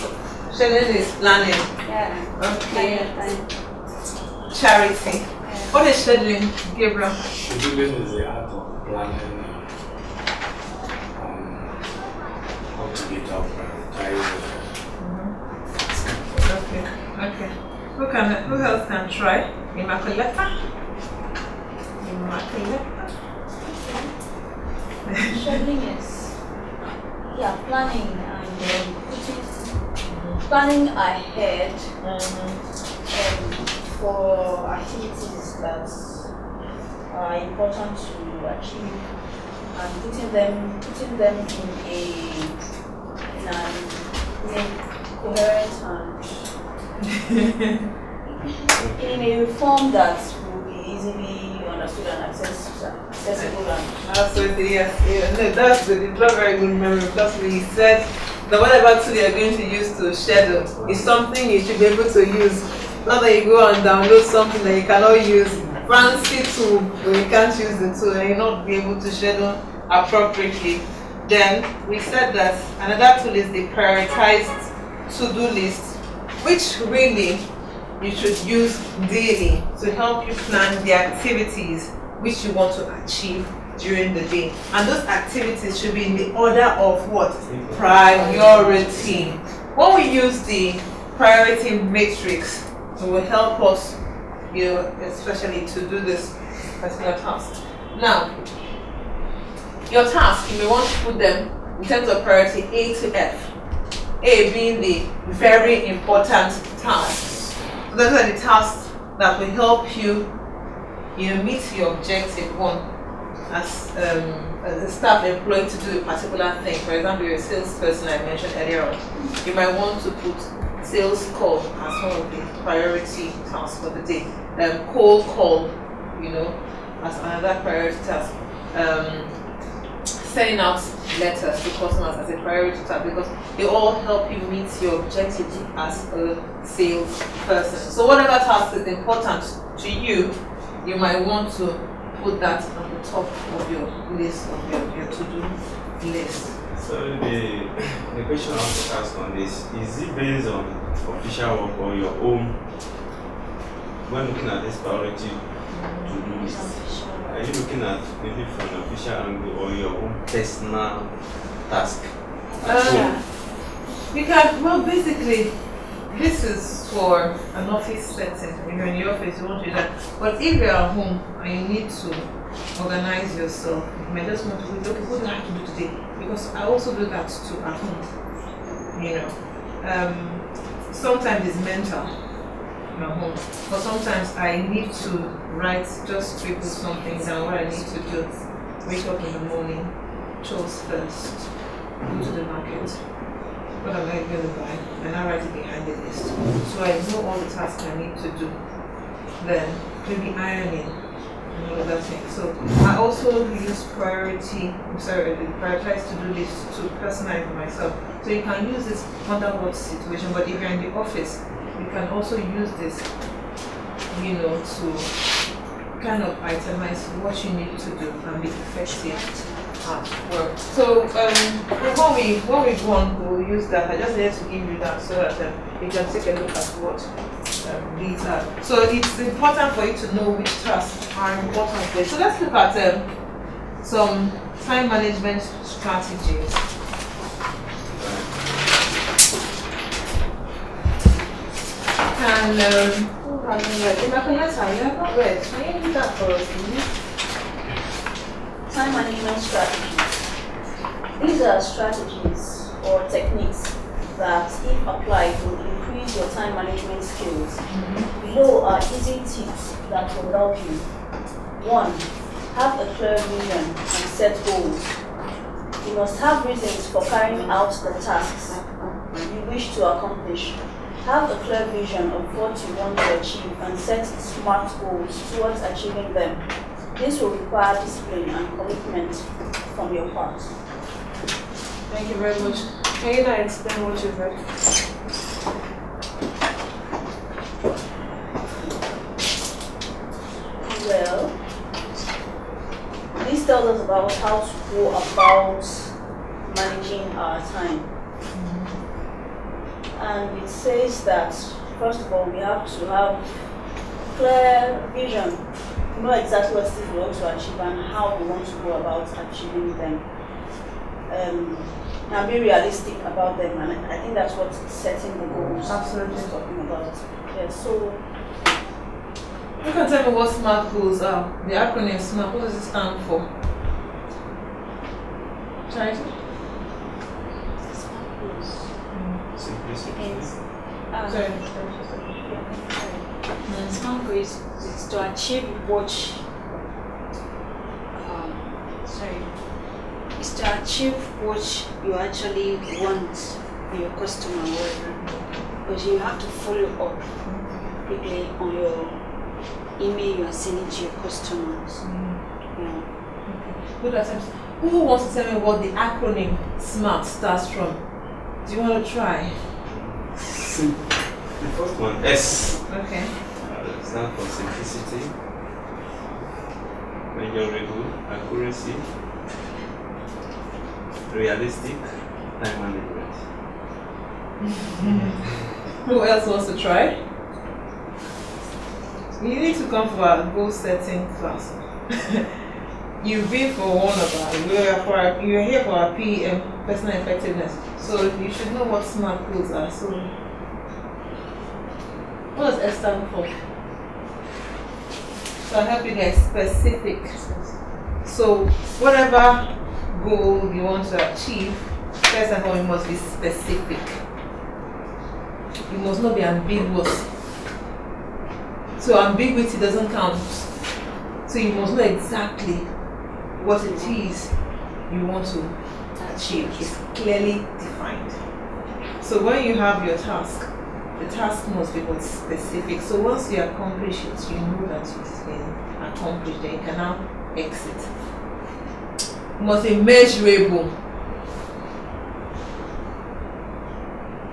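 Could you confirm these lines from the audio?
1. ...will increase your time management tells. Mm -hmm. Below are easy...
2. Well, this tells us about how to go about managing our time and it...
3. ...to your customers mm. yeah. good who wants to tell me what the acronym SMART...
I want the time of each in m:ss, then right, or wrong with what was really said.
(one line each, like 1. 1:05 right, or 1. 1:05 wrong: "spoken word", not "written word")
1. 4:15 wrong: "skills", not "tells"
2. 4:50 right
3. 5:50 right.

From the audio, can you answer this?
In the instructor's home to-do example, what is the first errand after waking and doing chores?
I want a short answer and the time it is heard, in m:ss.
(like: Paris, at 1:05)
Go to the market, at 3:11.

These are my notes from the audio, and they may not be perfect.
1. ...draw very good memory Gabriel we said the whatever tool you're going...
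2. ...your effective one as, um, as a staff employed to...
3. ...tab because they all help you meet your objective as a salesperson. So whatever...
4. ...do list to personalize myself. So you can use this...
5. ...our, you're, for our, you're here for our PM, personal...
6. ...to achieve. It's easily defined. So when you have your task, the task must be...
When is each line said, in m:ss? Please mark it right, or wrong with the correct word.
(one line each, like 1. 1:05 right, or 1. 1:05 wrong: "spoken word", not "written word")
1. 0:56 wrong: "Plus", not "Gabriel"
2. 1:51 wrong: "objective", not "effective"
3. 2:12 right
4. 3:26 right
5. 6:24 right
6. 6:55 wrong: "clearly", not "easily".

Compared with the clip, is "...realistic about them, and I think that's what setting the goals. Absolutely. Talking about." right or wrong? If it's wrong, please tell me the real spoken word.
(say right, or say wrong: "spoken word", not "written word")
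right.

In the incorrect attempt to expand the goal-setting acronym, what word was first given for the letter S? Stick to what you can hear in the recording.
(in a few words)
Simplicity.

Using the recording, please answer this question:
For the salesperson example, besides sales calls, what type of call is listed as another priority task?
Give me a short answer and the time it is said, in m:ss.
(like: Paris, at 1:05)
Cold call, at 2:04.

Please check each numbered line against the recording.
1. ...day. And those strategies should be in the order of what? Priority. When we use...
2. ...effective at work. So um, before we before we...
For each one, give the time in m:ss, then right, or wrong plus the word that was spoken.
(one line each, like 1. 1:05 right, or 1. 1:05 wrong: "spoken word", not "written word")
1. 1:24 wrong: "activities", not "strategies"
2. 3:38 right.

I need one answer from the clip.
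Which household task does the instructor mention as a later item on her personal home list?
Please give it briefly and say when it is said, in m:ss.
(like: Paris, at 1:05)
Ironing, at 3:20.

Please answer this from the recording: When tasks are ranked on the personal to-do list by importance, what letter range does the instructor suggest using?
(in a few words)
A to F.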